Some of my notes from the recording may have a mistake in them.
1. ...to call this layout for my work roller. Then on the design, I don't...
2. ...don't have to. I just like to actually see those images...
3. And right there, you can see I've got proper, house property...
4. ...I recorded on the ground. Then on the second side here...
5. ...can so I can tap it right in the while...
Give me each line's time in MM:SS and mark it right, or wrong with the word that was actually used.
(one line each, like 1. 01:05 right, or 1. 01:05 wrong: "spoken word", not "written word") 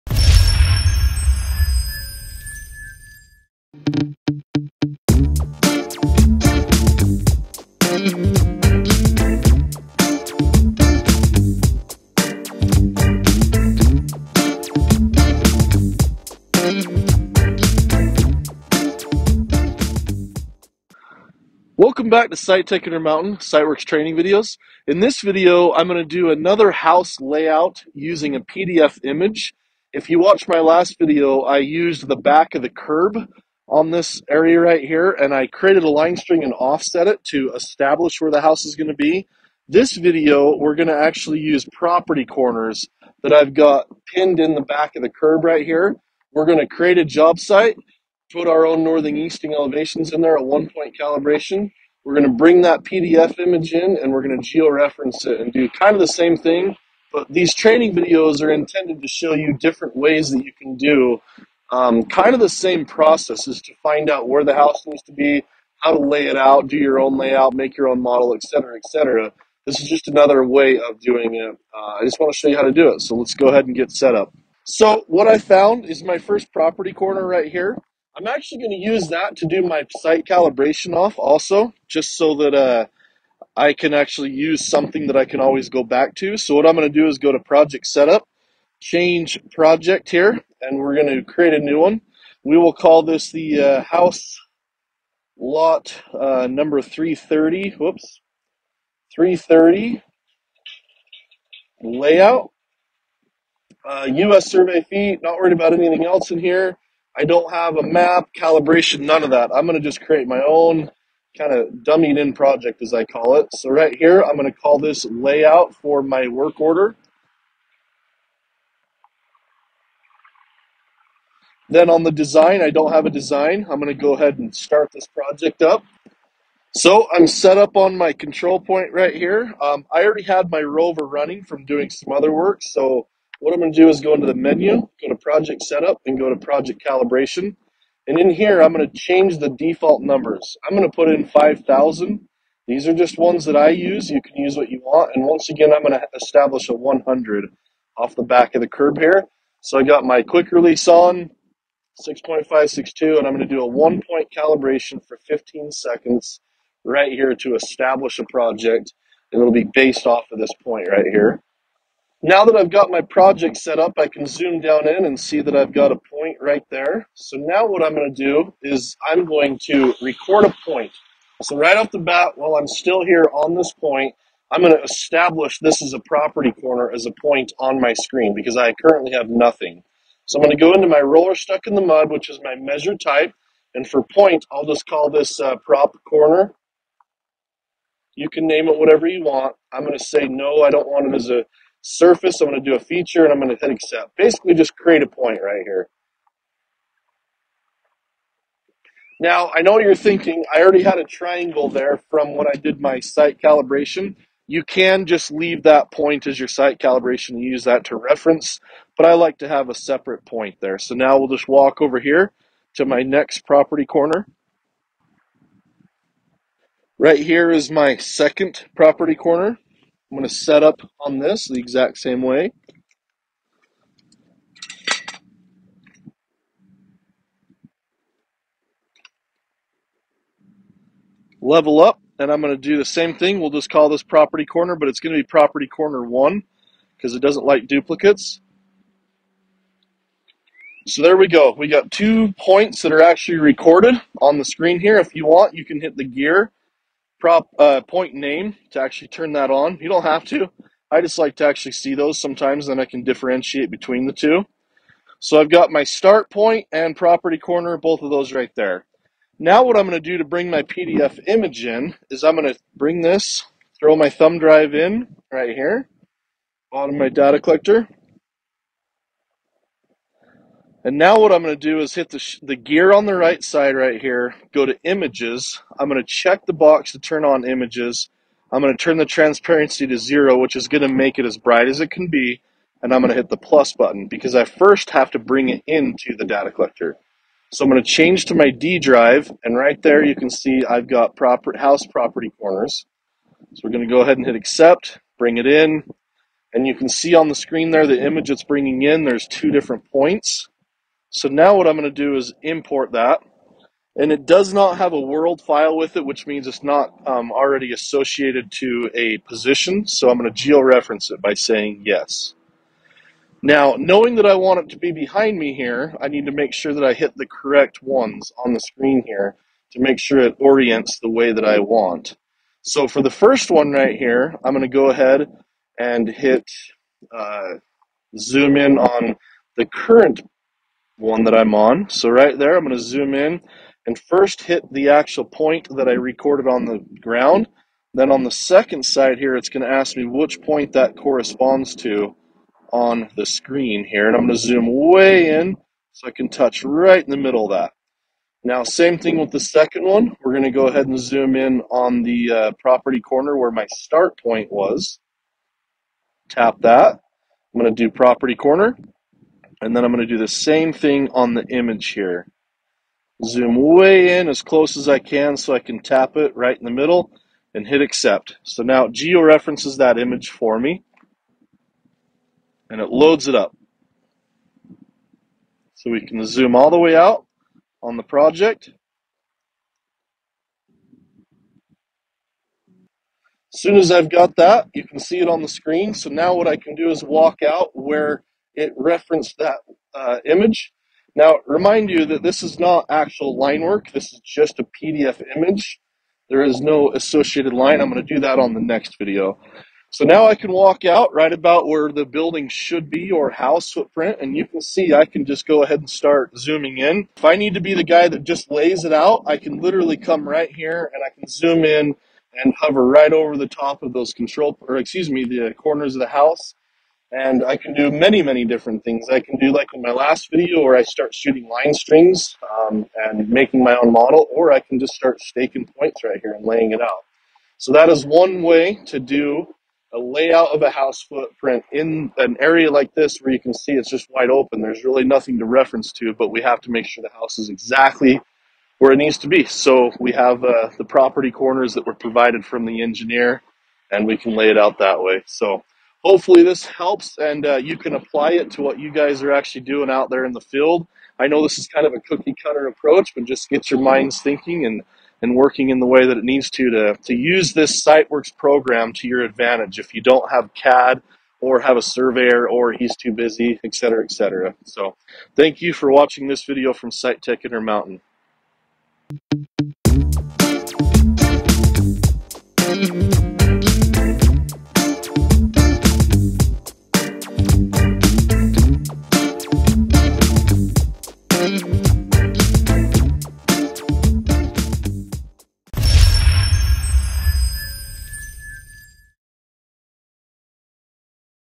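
1. 01:54 wrong: "order", not "roller"
2. 04:09 wrong: "sometimes", not "images"
3. 04:49 right
4. 05:35 right
5. 06:04 wrong: "middle", not "while".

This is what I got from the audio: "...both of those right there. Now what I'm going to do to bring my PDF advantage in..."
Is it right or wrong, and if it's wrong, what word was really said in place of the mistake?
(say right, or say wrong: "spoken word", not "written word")
wrong: "image", not "advantage".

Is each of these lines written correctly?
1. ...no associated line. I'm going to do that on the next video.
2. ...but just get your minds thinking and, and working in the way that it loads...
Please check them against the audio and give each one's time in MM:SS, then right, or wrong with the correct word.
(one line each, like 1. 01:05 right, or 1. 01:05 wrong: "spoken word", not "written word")
1. 06:36 right
2. 07:33 wrong: "needs", not "loads".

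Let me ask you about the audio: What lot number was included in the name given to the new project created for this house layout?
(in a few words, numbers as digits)
330.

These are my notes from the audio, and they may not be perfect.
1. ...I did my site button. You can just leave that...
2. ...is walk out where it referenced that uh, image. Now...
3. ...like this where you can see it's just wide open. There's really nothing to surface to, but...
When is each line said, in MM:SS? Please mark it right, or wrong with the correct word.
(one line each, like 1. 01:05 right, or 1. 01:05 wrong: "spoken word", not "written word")
1. 03:22 wrong: "calibration", not "button"
2. 06:26 right
3. 07:12 wrong: "reference", not "surface".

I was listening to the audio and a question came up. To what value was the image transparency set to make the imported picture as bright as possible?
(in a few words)
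zero.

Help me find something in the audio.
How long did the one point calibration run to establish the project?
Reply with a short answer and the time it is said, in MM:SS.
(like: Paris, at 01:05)
15 seconds, at 02:35.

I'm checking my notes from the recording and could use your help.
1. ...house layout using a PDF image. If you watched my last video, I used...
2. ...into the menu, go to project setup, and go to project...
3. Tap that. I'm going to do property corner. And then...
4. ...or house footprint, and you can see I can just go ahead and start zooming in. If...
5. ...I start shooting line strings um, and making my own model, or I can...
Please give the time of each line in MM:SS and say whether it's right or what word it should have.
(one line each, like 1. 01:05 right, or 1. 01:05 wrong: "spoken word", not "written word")
1. 00:26 right
2. 02:14 right
3. 05:56 right
4. 06:43 right
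5. 07:00 right.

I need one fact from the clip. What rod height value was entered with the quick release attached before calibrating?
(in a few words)
6.562.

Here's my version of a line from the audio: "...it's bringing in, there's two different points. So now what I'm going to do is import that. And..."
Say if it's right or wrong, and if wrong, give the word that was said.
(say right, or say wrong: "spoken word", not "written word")
right.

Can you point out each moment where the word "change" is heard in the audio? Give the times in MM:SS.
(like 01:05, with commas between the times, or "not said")
01:28, 02:18, 04:47.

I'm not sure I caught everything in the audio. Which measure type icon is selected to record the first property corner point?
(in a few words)
roller stuck in the mud.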